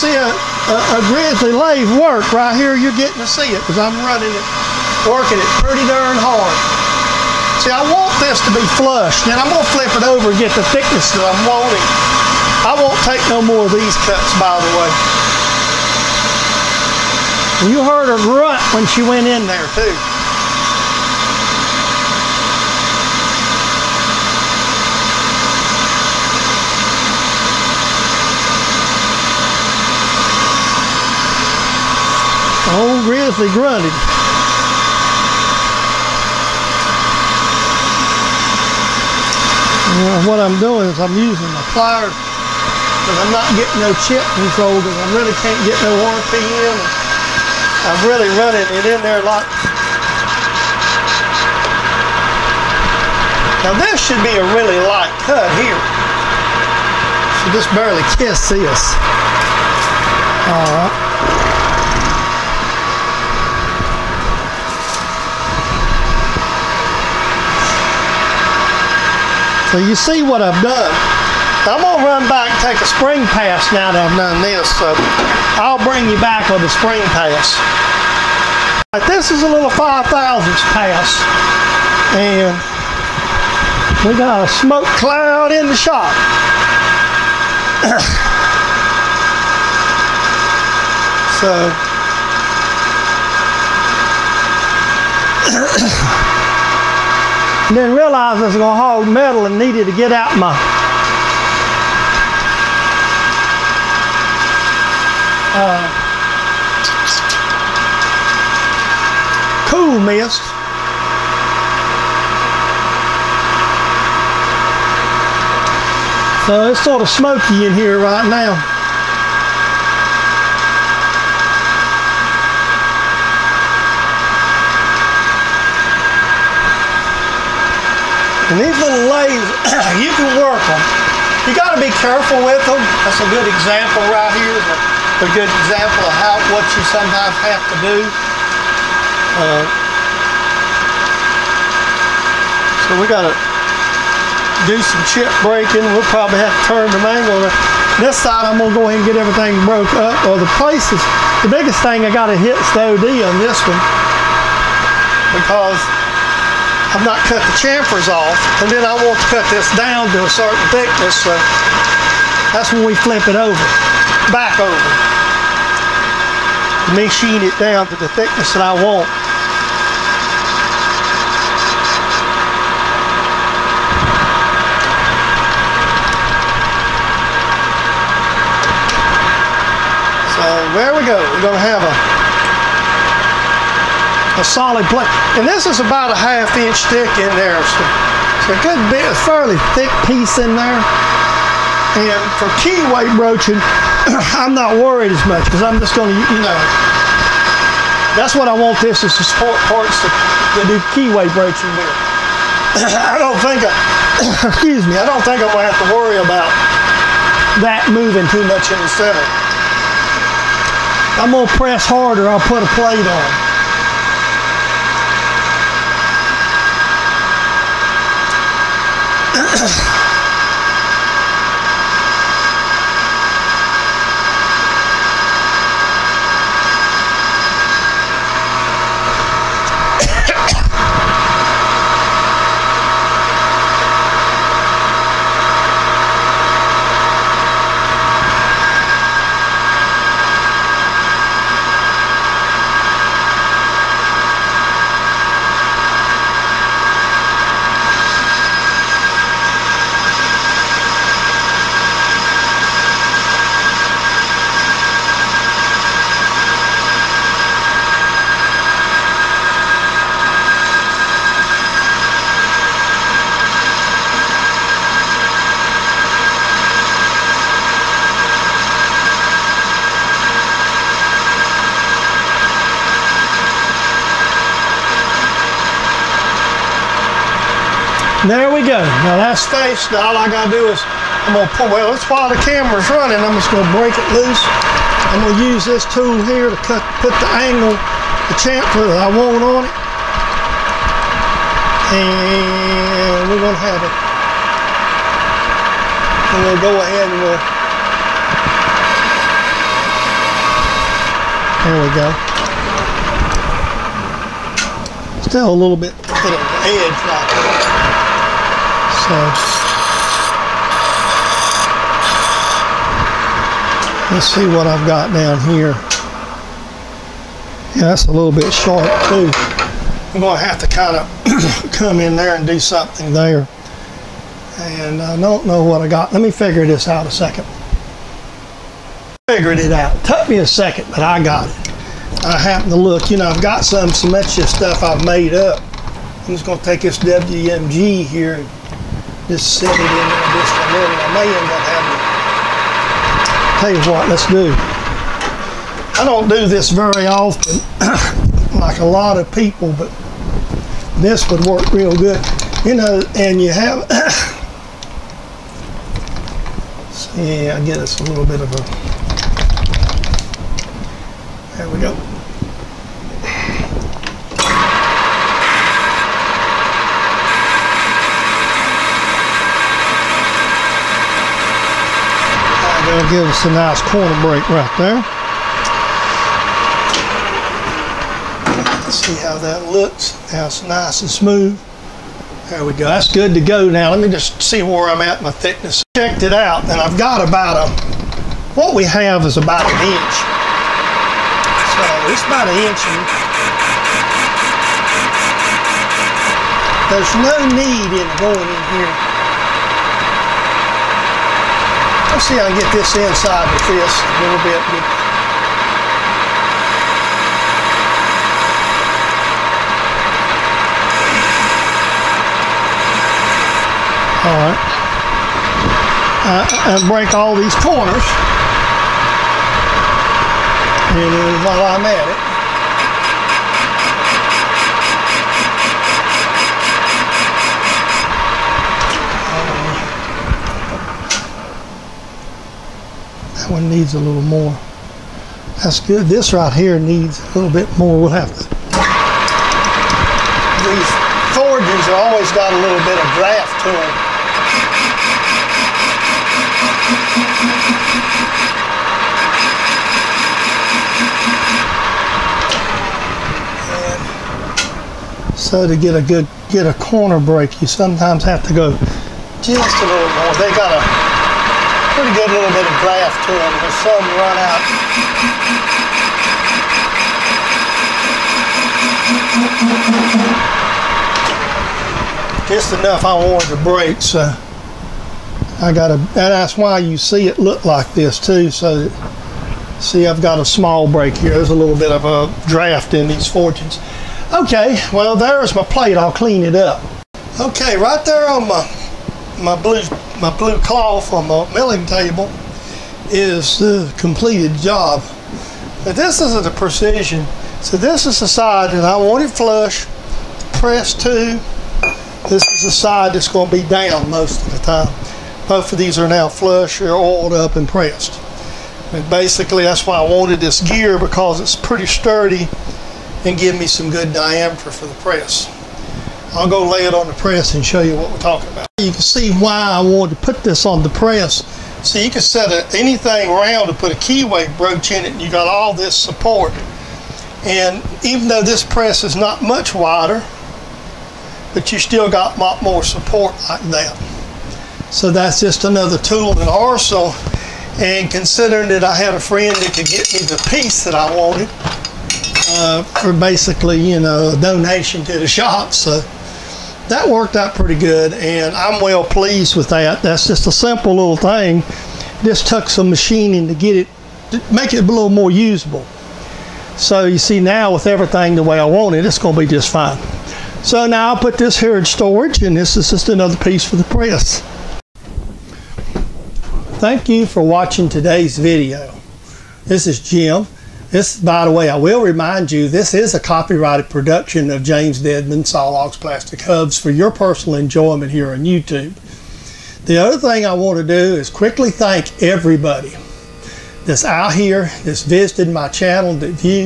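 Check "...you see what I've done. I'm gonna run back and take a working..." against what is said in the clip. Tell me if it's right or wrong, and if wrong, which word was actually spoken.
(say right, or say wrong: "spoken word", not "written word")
wrong: "spring", not "working".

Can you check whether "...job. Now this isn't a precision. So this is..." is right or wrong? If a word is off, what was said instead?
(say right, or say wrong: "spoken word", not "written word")
right.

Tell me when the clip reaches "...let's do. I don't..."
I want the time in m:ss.
5:44.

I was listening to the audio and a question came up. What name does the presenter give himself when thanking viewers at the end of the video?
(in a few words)
Jim.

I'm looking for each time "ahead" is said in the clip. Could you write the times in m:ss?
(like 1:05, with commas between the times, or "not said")
2:28, 4:56.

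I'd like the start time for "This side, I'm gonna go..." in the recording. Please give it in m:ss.
2:28.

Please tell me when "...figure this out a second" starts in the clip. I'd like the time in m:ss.
5:26.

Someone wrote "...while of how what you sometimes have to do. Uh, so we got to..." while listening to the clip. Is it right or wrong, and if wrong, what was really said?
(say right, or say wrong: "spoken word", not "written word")
wrong: "example", not "while".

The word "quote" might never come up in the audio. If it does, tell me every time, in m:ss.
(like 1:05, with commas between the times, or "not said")
not said.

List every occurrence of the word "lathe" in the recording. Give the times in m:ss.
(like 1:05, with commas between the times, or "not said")
0:01, 2:09.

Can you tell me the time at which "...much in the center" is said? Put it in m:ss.
3:28.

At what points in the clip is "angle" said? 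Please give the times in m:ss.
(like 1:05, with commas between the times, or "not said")
2:27, 4:47.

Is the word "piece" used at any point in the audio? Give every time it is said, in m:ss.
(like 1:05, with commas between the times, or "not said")
3:10, 9:00, 9:23.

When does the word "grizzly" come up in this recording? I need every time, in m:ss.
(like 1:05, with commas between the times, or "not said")
0:01, 0:33.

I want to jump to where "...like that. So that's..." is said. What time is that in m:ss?
8:53.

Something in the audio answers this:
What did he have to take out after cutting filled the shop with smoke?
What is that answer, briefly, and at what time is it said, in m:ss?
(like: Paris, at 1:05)
cool mist, at 1:49.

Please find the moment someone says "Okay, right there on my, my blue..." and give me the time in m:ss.
8:07.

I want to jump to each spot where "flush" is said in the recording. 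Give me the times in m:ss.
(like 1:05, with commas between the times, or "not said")
0:08, 8:19, 8:26.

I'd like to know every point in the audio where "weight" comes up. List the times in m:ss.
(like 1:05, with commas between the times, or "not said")
3:12, 3:21.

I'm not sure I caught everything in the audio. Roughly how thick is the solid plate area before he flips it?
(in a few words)
half inch.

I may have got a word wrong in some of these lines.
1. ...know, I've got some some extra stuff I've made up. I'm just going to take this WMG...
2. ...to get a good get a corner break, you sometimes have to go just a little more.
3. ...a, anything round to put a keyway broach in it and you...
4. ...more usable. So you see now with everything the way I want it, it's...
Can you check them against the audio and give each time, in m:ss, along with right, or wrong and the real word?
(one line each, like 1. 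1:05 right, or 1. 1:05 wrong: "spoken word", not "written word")
1. 5:33 right
2. 7:35 right
3. 8:42 right
4. 9:15 right.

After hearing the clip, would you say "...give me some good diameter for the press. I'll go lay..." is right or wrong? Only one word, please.
right.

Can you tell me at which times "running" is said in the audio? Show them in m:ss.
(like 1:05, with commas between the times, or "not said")
0:04, 0:48, 4:42.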